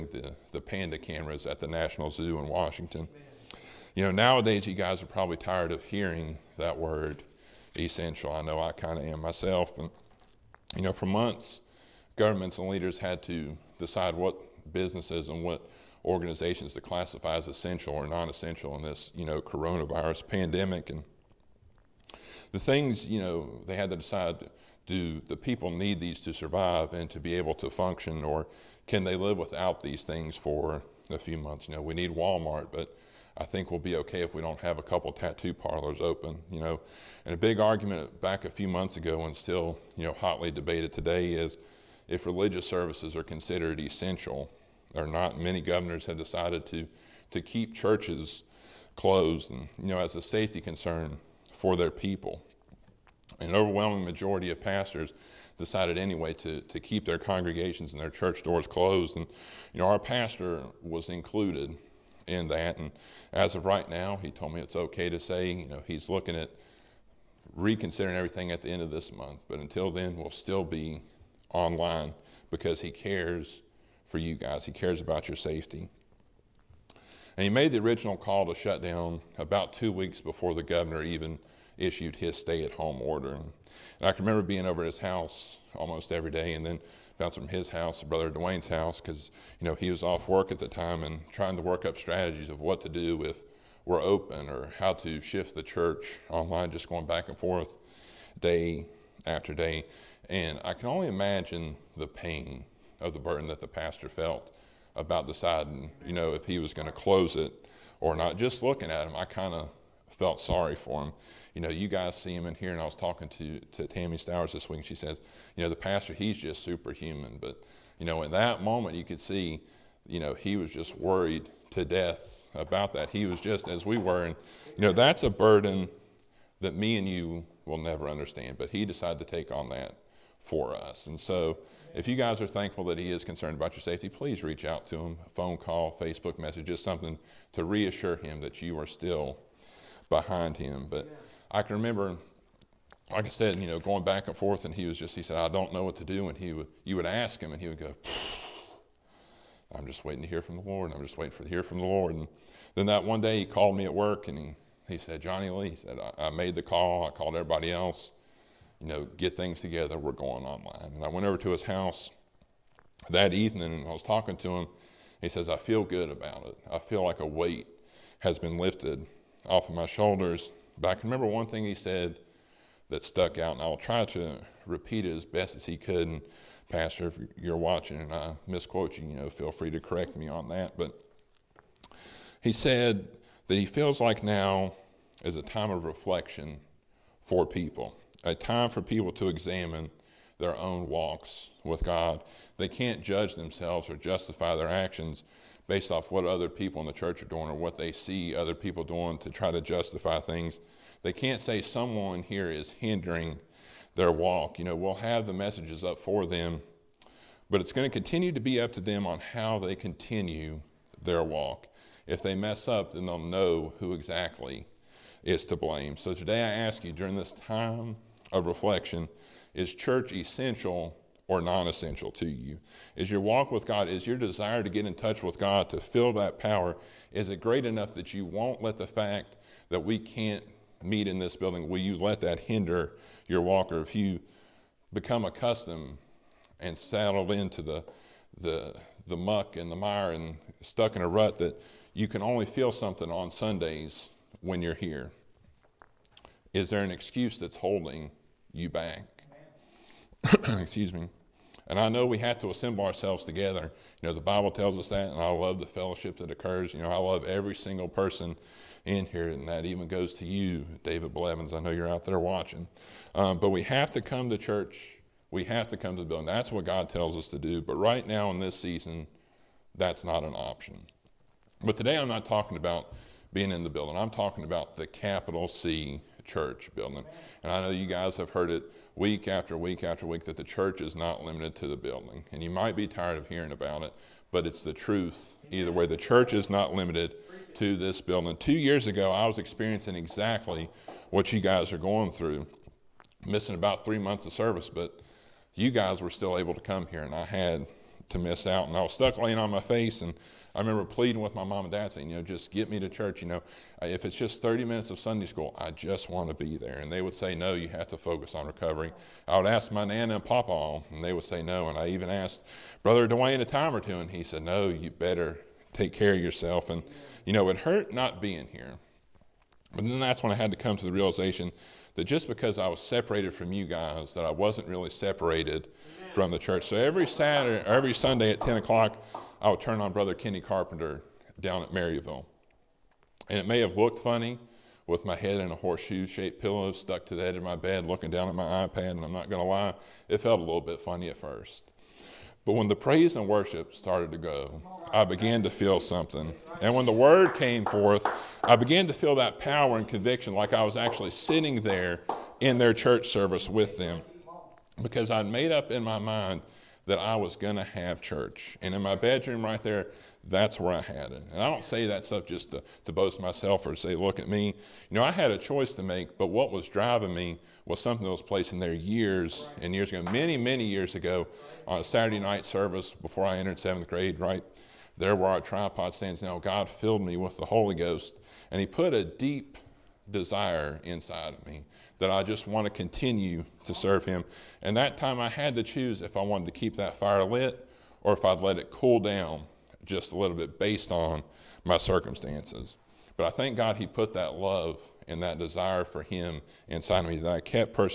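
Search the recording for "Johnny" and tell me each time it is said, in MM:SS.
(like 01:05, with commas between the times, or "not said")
02:35.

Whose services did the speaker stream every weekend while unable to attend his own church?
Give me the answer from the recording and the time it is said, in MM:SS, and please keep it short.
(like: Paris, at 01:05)
Kenny Carpenter, at 05:30.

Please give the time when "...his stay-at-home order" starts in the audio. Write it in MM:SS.
01:22.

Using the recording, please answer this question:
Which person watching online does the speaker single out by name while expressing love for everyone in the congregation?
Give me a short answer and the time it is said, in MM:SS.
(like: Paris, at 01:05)
David Blevins, at 04:20.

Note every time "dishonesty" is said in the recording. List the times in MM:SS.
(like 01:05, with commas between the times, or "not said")
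not said.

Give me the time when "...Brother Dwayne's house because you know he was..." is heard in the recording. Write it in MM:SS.
01:28.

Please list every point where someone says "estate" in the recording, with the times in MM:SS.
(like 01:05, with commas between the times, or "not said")
not said.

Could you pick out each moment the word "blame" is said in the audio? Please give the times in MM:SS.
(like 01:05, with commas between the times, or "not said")
03:35.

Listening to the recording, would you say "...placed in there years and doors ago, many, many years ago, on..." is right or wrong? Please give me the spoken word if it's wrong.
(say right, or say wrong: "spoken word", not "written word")
wrong: "years", not "doors".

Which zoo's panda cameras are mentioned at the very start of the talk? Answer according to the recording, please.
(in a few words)
National Zoo.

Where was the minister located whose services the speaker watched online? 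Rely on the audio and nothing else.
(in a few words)
Maryville.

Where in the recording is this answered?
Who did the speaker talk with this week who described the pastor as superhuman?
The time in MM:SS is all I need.
01:53.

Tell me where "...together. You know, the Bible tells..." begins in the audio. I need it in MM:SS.
04:13.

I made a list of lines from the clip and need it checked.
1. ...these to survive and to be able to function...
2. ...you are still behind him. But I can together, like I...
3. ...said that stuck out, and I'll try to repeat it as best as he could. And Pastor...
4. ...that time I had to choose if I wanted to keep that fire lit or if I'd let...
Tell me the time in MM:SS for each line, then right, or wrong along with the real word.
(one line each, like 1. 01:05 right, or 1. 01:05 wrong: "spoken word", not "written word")
1. 00:25 right
2. 02:18 wrong: "remember", not "together"
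3. 02:51 right
4. 06:24 right.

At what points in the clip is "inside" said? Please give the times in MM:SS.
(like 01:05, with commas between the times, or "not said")
06:20, 06:36.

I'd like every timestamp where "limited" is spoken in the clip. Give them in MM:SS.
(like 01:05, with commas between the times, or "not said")
04:41, 04:46.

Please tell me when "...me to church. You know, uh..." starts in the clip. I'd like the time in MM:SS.
05:02.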